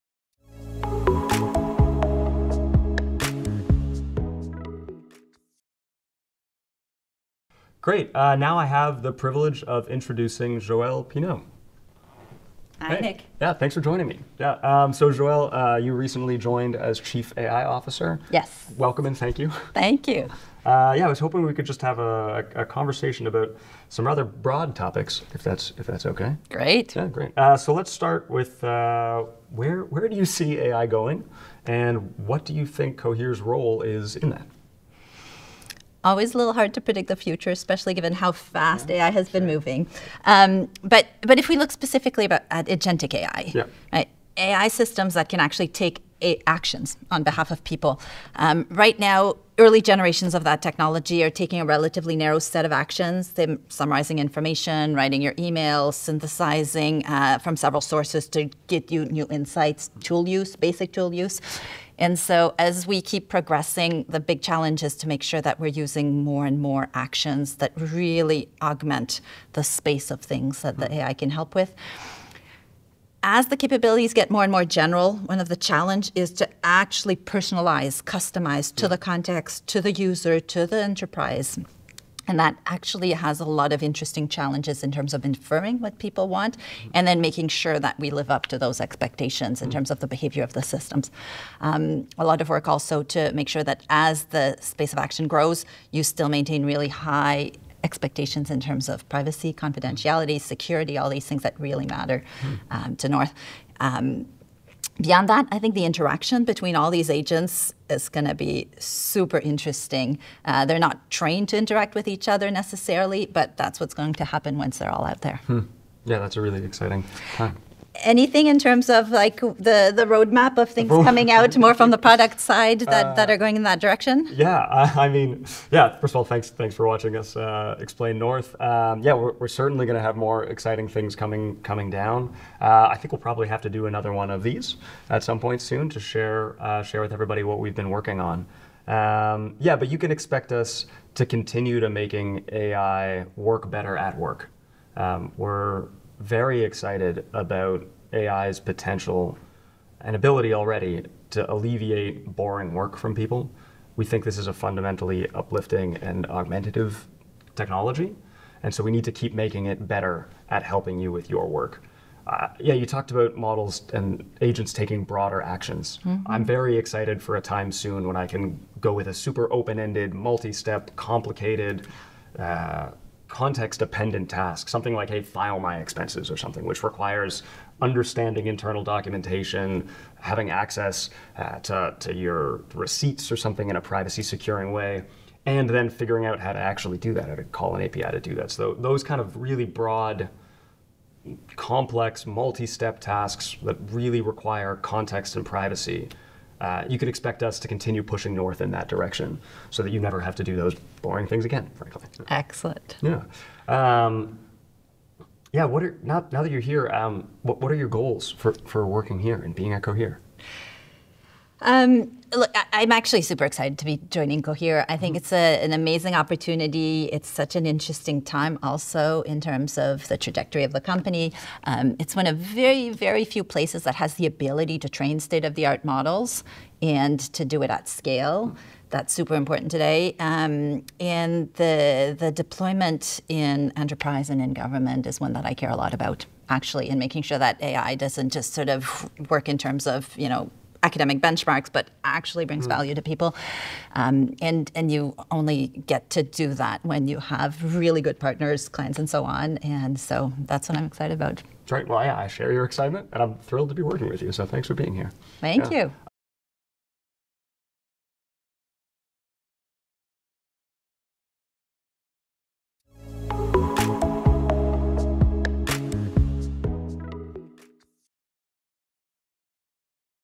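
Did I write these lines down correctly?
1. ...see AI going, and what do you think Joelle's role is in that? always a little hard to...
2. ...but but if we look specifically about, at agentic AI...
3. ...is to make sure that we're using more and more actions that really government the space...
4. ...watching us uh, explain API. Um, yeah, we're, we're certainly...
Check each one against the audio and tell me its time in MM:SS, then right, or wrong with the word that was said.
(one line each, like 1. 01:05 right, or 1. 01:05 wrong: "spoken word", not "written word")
1. 00:30 wrong: "Cohere", not "Joelle"
2. 00:40 right
3. 01:04 wrong: "augment", not "government"
4. 02:06 wrong: "North", not "API".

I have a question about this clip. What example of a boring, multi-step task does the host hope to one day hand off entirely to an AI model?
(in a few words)
file my expenses.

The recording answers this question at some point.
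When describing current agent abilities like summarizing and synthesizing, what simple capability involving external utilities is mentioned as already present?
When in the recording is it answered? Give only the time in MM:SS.
01:00.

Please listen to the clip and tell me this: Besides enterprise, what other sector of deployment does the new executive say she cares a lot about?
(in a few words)
government.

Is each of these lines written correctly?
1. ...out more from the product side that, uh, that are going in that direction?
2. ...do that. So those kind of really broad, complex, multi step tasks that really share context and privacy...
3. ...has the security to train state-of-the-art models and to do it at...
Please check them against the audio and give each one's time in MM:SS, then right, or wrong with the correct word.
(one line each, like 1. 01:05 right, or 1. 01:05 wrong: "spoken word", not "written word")
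1. 02:01 right
2. 03:08 wrong: "require", not "share"
3. 03:43 wrong: "ability", not "security".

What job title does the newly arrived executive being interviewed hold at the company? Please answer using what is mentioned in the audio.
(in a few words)
Chief AI Officer.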